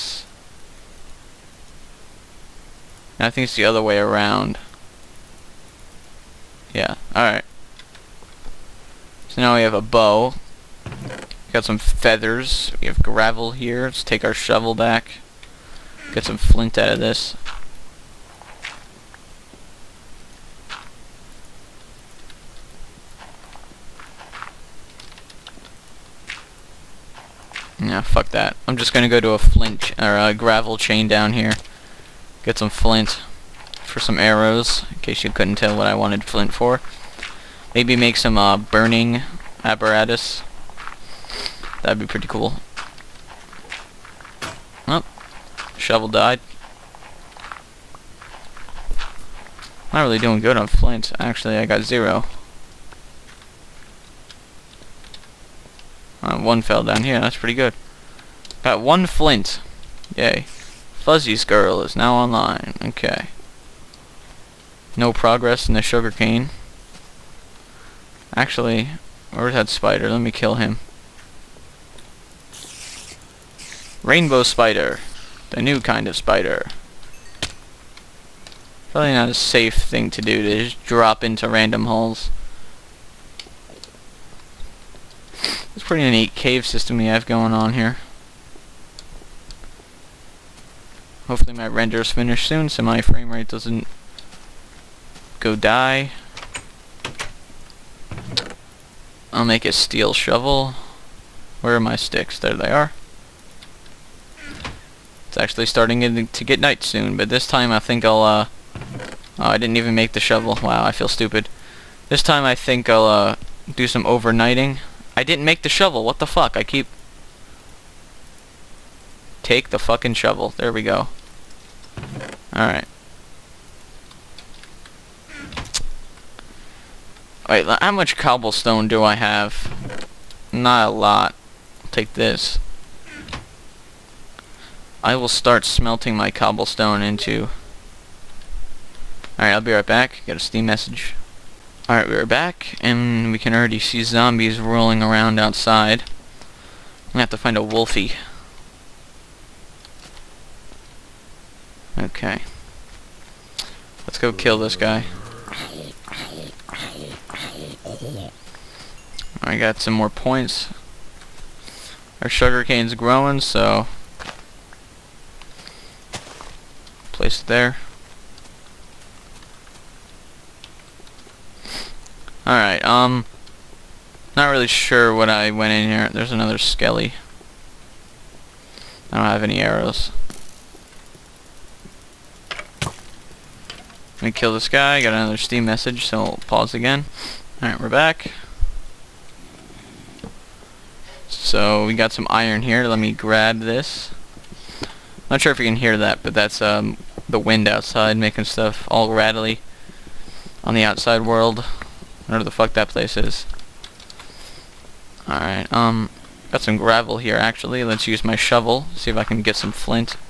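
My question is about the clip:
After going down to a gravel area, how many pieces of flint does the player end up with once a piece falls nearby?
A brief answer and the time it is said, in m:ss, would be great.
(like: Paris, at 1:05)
1, at 0:58.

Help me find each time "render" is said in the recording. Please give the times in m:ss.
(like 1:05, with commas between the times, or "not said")
1:31.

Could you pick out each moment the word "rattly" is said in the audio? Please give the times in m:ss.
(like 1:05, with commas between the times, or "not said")
3:19.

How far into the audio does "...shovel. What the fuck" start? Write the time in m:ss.
1:55.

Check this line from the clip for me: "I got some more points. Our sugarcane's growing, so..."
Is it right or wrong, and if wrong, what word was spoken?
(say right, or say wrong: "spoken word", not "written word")
right.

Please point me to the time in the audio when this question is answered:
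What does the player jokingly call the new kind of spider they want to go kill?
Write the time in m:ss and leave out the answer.
1:14.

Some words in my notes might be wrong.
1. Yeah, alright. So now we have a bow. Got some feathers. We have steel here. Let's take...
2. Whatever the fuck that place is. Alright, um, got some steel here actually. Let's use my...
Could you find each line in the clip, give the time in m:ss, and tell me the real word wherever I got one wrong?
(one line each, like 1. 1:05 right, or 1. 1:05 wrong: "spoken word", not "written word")
1. 0:06 wrong: "gravel", not "steel"
2. 3:22 wrong: "gravel", not "steel".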